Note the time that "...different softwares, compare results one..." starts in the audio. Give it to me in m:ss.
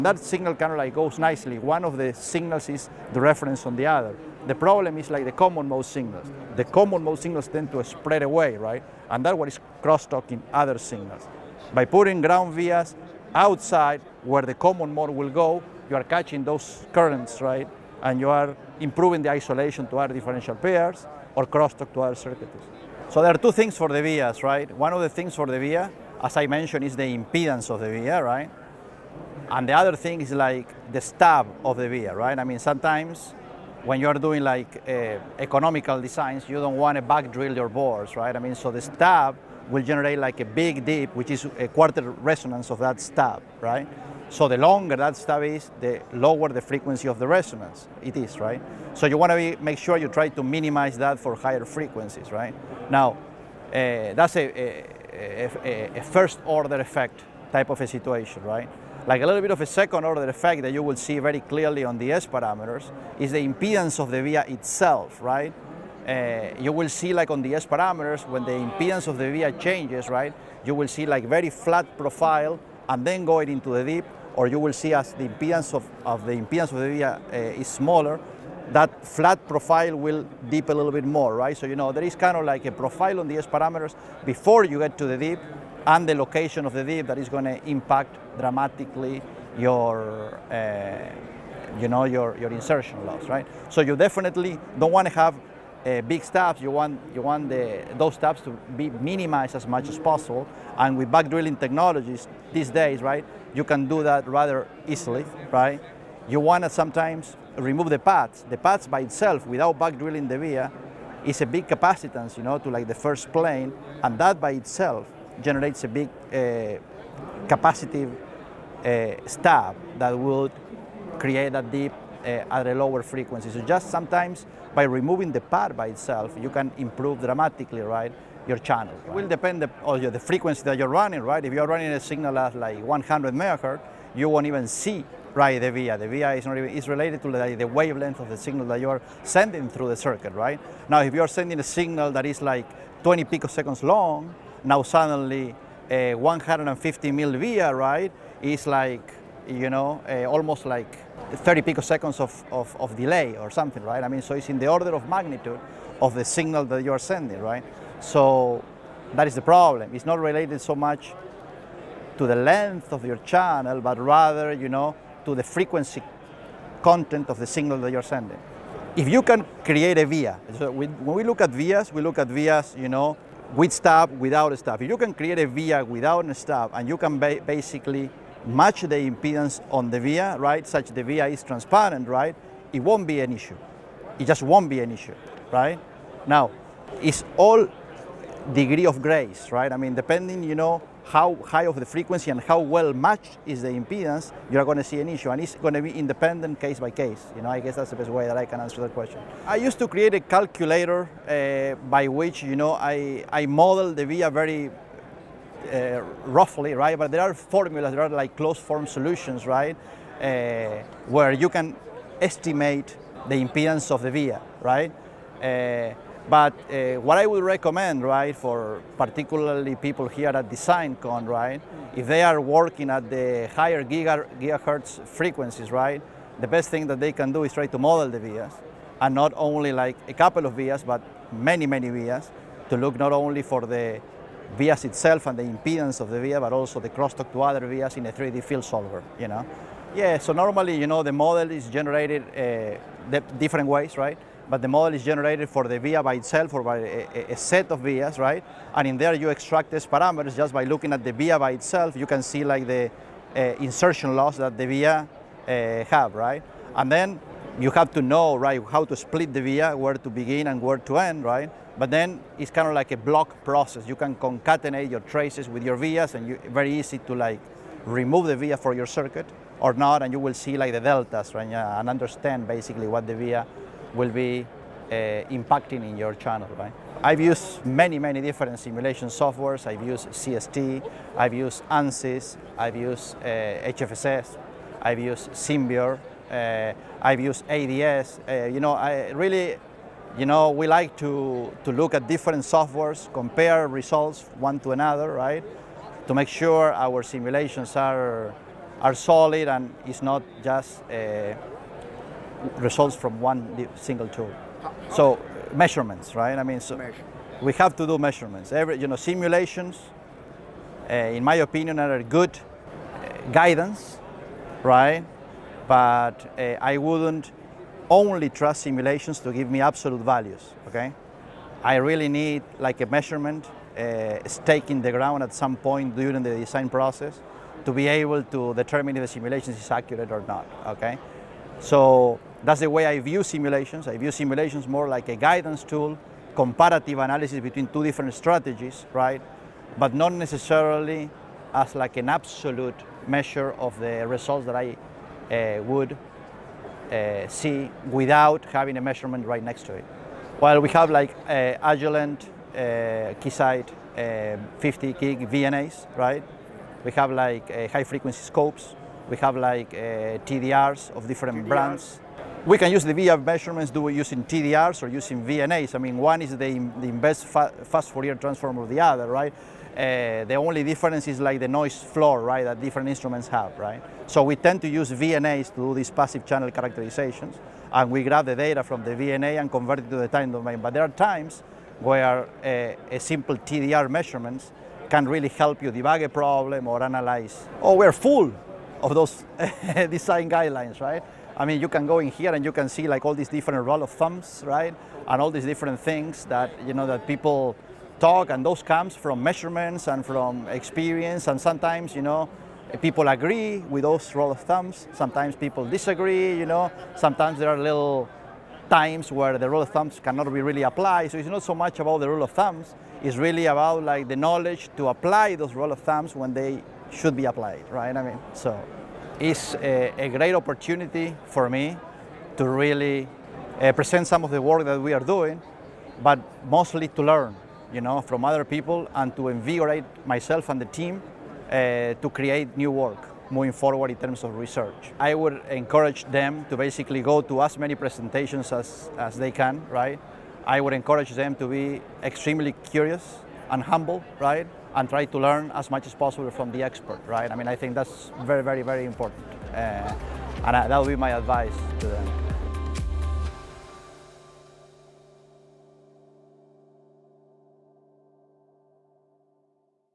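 4:52.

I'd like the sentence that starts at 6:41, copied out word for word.
And sometimes, you know, people agree with those roll of thumbs.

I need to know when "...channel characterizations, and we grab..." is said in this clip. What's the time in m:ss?
6:16.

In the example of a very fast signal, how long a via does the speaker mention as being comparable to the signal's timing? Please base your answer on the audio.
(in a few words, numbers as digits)
150 mil.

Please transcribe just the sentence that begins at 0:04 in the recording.
The problem is like the common mode signals.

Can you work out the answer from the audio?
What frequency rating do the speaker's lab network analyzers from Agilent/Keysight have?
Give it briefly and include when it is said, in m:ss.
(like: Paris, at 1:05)
50 gig, at 5:54.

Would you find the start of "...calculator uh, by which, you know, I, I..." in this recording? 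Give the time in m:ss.
3:20.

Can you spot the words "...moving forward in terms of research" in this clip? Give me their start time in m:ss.
7:13.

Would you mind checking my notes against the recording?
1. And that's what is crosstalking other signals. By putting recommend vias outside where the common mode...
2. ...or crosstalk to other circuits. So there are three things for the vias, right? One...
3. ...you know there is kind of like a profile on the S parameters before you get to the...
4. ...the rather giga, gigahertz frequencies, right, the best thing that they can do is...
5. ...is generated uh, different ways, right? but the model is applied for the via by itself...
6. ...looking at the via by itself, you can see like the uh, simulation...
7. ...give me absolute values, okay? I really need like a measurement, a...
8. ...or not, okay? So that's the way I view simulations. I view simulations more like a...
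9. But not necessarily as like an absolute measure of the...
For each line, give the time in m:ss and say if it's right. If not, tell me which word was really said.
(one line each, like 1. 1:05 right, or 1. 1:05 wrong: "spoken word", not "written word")
1. 0:09 wrong: "ground", not "recommend"
2. 0:21 wrong: "two", not "three"
3. 1:21 right
4. 3:43 wrong: "higher", not "rather"
5. 4:01 wrong: "generated", not "applied"
6. 4:10 wrong: "insertion", not "simulation"
7. 5:19 right
8. 5:30 right
9. 5:39 right.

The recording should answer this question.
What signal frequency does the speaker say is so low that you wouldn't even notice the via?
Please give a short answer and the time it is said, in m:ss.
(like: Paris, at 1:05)
100 megahertz, at 2:12.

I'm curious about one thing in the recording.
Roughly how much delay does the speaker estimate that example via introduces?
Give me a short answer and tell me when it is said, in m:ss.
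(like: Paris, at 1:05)
30 picoseconds, at 2:31.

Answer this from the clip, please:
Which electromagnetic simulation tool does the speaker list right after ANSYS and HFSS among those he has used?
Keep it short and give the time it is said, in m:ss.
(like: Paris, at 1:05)
Simbeor, at 4:45.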